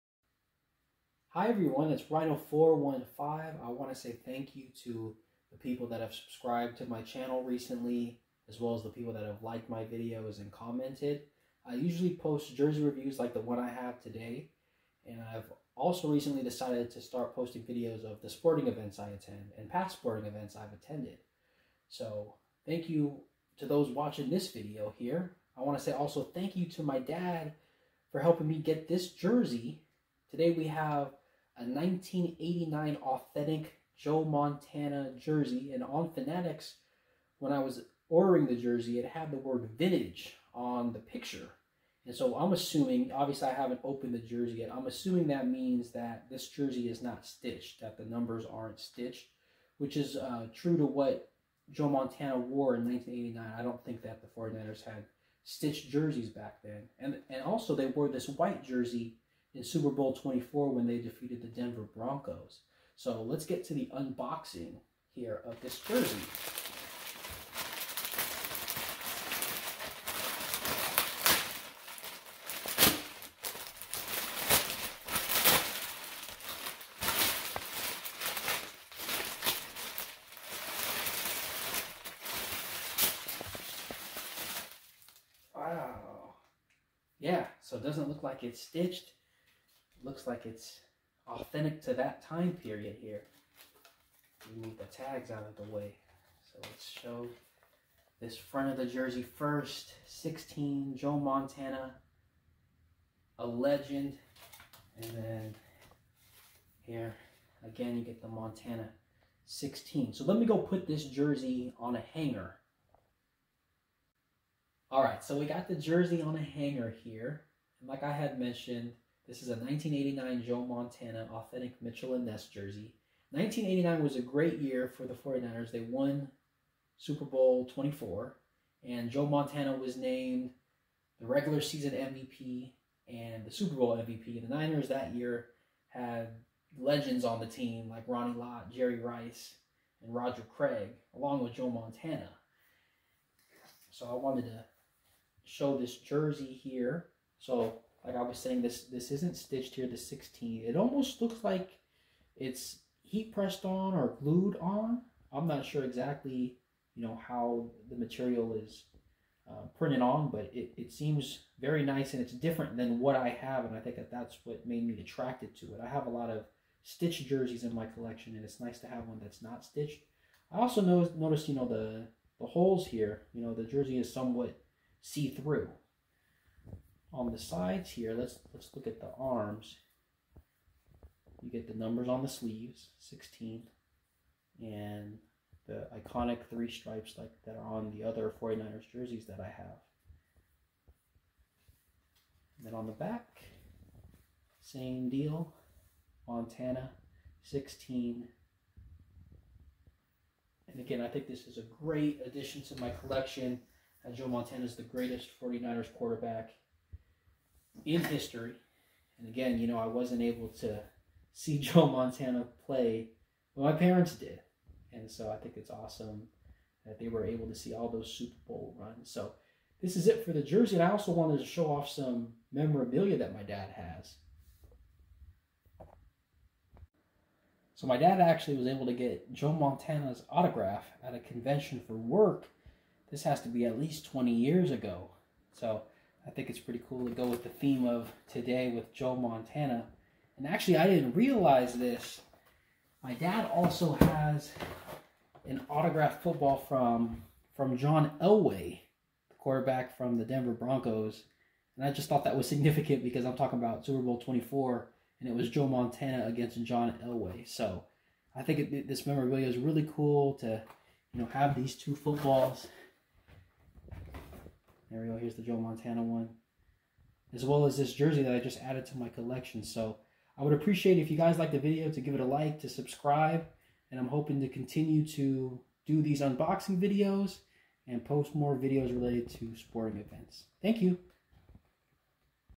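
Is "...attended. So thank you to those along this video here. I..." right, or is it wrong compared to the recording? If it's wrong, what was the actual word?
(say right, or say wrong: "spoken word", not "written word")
wrong: "watching", not "along".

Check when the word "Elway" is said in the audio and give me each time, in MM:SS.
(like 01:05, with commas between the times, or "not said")
04:08, 04:17.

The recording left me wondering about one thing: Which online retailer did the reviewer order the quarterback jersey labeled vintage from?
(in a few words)
Fanatics.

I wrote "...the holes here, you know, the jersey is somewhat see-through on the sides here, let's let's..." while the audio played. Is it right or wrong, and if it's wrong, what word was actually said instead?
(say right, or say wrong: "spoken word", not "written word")
right.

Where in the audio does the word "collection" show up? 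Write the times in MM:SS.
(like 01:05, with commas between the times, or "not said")
02:47, 03:23, 04:29.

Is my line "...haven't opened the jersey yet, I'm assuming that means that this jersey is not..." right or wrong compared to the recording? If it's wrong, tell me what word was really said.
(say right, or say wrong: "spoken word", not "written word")
right.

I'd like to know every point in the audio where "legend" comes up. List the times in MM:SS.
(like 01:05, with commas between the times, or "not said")
01:43, 02:16.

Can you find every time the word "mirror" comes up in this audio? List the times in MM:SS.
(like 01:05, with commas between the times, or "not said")
not said.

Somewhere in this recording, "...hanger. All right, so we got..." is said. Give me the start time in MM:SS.
01:52.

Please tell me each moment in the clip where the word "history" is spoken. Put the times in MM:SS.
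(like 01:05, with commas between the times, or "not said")
03:28.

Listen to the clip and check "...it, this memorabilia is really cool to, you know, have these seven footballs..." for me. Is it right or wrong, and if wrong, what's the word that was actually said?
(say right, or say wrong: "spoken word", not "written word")
wrong: "two", not "seven".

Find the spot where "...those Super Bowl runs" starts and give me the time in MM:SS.
03:37.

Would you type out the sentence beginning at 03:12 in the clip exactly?
And then on the back, same deal, Montana 16.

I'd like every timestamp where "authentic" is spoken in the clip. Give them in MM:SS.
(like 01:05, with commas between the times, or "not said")
00:33, 01:31, 02:01.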